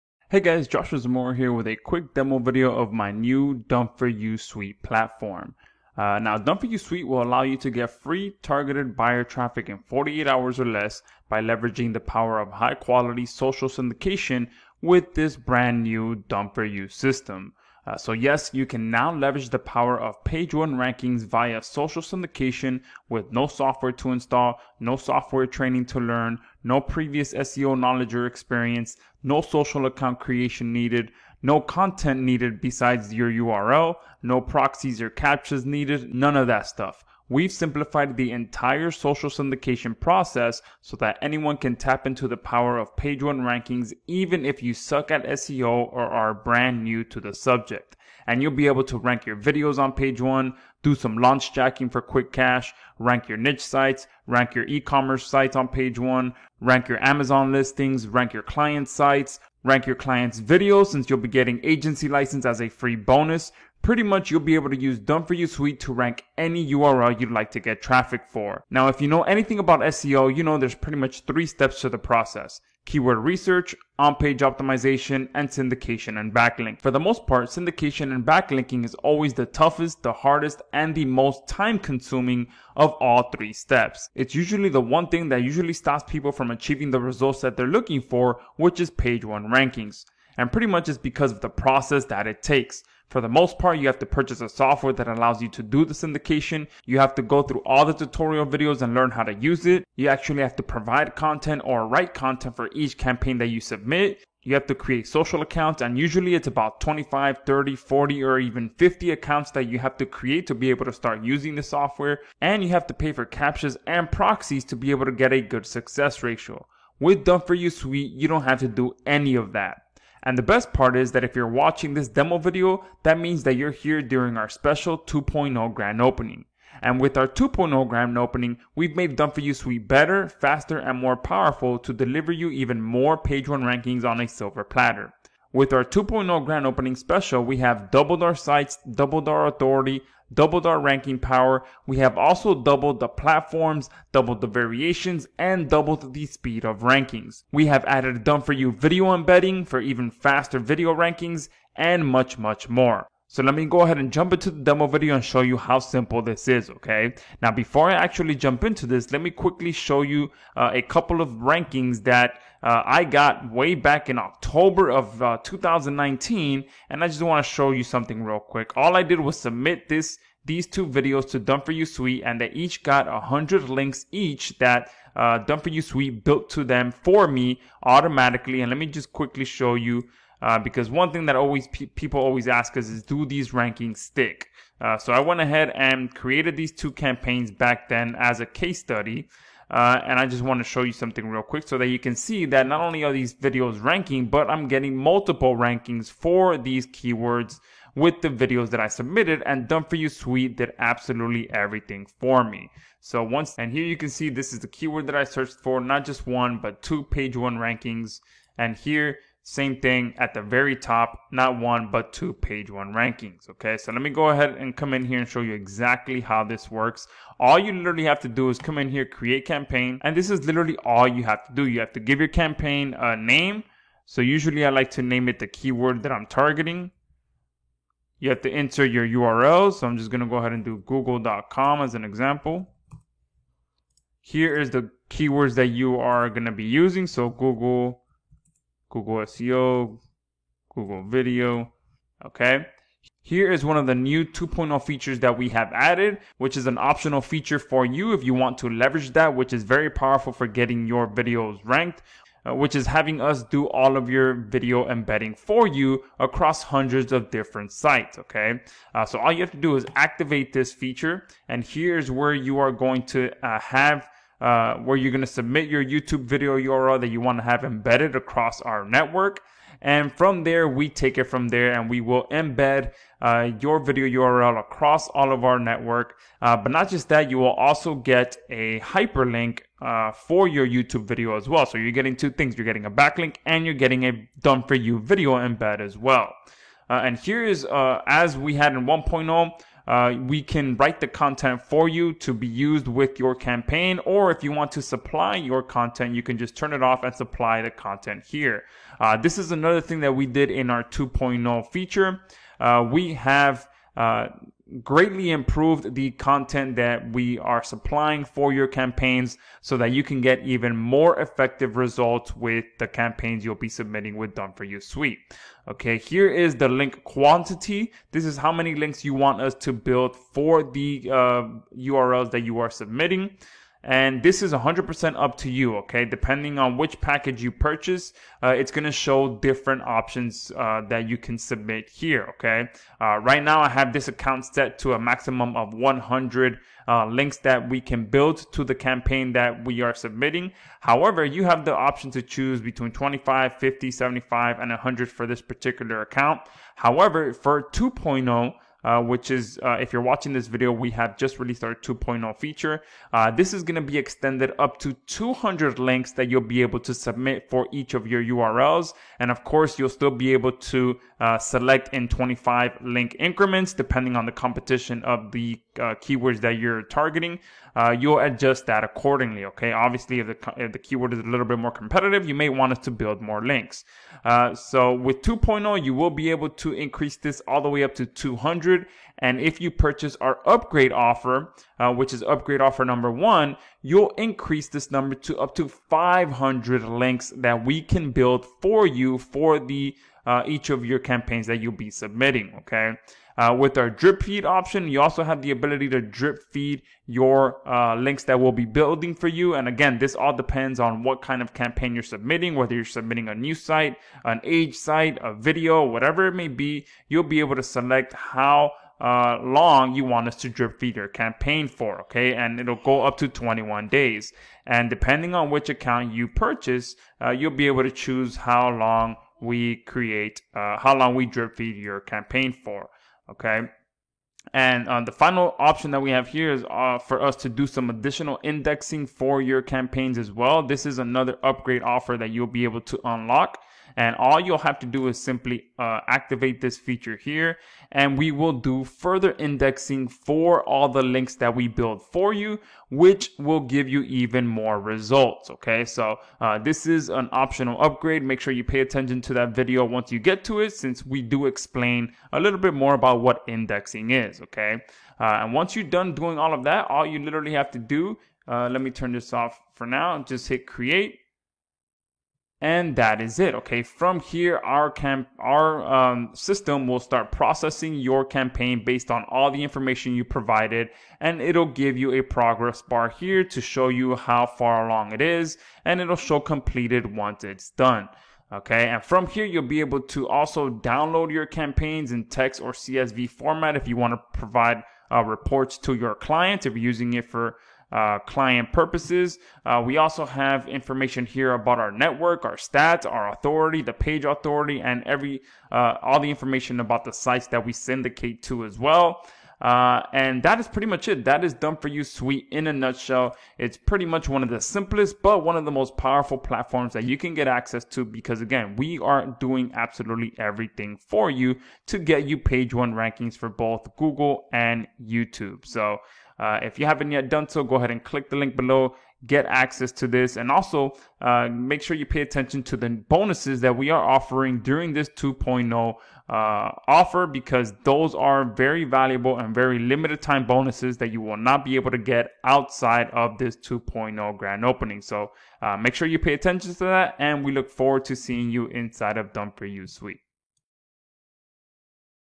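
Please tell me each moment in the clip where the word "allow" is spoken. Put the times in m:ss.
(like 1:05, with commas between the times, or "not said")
0:07, 1:35.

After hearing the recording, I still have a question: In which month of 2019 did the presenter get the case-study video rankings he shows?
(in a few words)
October.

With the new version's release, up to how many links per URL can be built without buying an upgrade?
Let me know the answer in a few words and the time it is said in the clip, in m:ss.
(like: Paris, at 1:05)
200, at 5:55.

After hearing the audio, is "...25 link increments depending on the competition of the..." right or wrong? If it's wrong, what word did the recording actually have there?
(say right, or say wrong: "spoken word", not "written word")
right.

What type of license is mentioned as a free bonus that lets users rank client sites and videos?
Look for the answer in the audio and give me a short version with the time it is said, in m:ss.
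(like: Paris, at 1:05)
agency license, at 1:01.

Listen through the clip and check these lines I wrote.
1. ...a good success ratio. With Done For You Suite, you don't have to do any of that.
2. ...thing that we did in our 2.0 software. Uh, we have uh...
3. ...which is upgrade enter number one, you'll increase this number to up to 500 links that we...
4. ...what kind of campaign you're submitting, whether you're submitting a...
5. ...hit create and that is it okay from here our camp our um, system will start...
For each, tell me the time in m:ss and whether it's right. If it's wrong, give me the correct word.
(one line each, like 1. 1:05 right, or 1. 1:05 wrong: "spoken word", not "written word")
1. 1:55 right
2. 4:59 wrong: "feature", not "software"
3. 6:21 wrong: "offer", not "enter"
4. 6:41 right
5. 7:40 right.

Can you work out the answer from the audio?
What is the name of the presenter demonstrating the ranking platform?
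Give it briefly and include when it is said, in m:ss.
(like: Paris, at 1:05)
Joshua Zamora, at 0:00.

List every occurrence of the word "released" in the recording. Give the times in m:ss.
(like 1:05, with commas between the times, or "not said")
5:51.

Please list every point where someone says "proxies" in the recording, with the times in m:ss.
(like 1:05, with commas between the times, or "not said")
0:34, 1:54.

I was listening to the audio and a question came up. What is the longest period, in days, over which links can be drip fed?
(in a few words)
21 days.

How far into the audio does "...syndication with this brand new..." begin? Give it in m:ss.
0:13.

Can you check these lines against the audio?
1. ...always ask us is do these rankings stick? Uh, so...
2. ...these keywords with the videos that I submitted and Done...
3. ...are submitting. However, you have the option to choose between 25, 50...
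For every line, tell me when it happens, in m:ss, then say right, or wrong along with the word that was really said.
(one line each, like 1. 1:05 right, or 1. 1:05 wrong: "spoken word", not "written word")
1. 3:02 right
2. 3:16 right
3. 5:39 right.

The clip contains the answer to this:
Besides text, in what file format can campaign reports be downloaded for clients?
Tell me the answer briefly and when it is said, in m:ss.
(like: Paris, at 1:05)
CSV, at 8:02.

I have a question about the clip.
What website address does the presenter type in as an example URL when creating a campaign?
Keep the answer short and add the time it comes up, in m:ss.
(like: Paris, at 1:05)
google.com, at 3:50.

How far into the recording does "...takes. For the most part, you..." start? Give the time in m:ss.
1:32.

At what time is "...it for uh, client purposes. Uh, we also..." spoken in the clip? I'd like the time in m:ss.
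8:07.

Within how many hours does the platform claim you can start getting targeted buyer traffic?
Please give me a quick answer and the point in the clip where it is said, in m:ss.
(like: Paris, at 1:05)
48, at 0:09.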